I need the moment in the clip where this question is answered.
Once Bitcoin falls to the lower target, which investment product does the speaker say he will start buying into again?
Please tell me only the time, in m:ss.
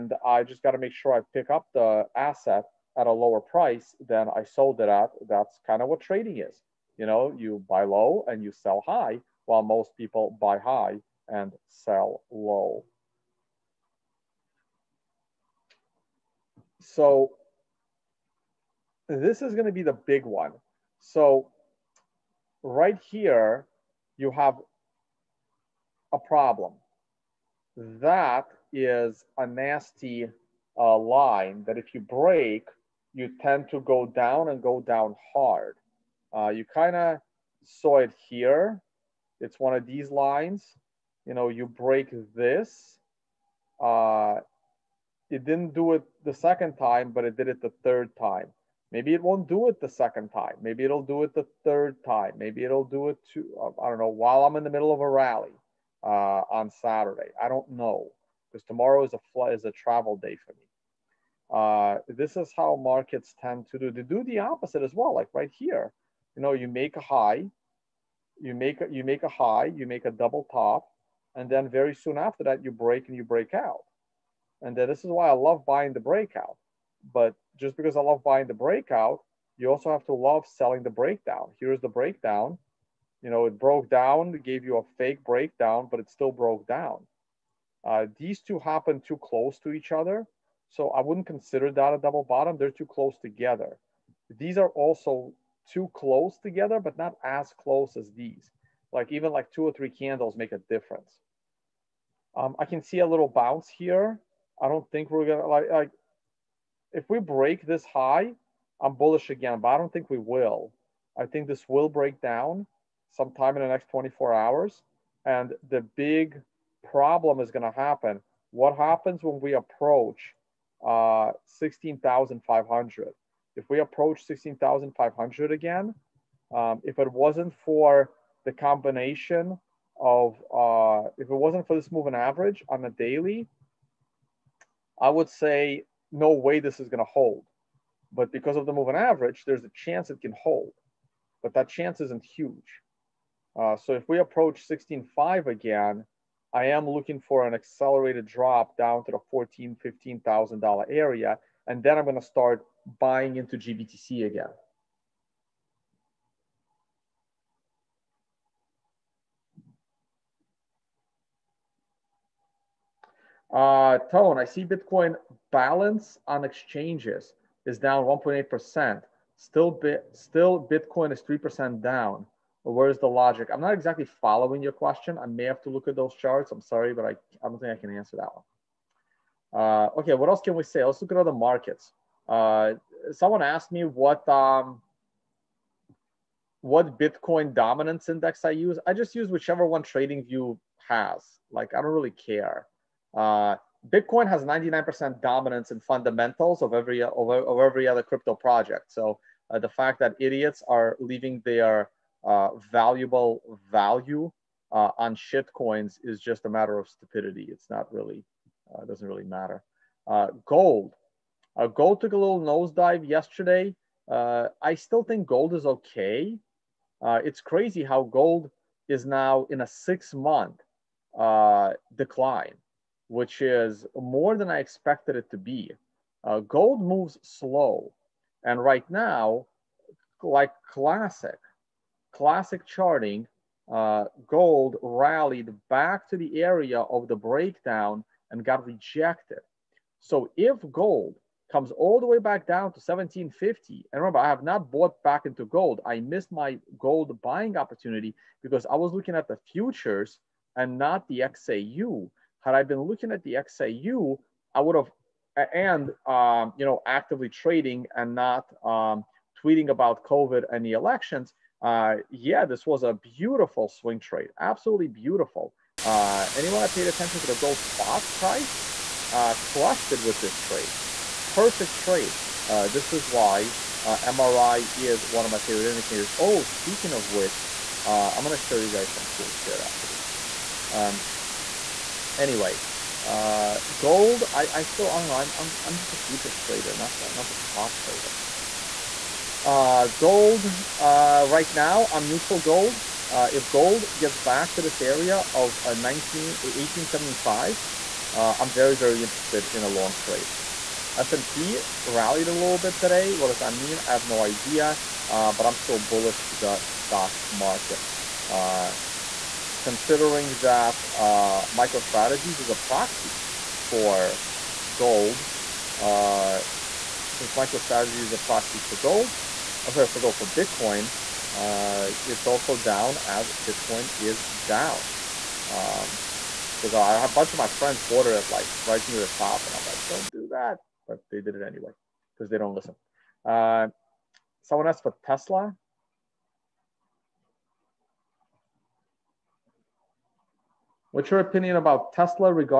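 2:33.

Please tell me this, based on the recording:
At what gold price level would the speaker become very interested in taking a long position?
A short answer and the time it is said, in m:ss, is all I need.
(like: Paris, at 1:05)
1875, at 4:56.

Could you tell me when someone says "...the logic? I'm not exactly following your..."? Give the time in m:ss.
2:52.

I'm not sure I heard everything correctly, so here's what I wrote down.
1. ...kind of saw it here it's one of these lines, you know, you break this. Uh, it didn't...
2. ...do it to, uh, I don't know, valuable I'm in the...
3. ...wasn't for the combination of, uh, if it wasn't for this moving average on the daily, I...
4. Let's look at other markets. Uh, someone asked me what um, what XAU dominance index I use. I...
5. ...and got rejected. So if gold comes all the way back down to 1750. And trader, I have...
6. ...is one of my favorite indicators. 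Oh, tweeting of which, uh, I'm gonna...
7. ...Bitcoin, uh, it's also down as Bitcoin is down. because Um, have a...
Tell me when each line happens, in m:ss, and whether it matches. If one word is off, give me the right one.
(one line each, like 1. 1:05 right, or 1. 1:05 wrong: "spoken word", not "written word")
1. 0:36 right
2. 0:52 wrong: "while", not "valuable"
3. 2:07 right
4. 3:00 wrong: "Bitcoin", not "XAU"
5. 3:58 wrong: "remember", not "trader"
6. 4:34 wrong: "speaking", not "tweeting"
7. 5:20 right.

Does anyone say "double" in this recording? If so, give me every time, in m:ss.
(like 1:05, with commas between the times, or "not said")
1:10, 1:31.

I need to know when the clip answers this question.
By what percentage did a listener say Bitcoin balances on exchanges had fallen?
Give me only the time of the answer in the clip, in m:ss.
2:48.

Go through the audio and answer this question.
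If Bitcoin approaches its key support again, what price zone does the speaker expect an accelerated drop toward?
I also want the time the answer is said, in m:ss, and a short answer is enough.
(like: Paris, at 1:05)
$14,000-$15,000, at 2:29.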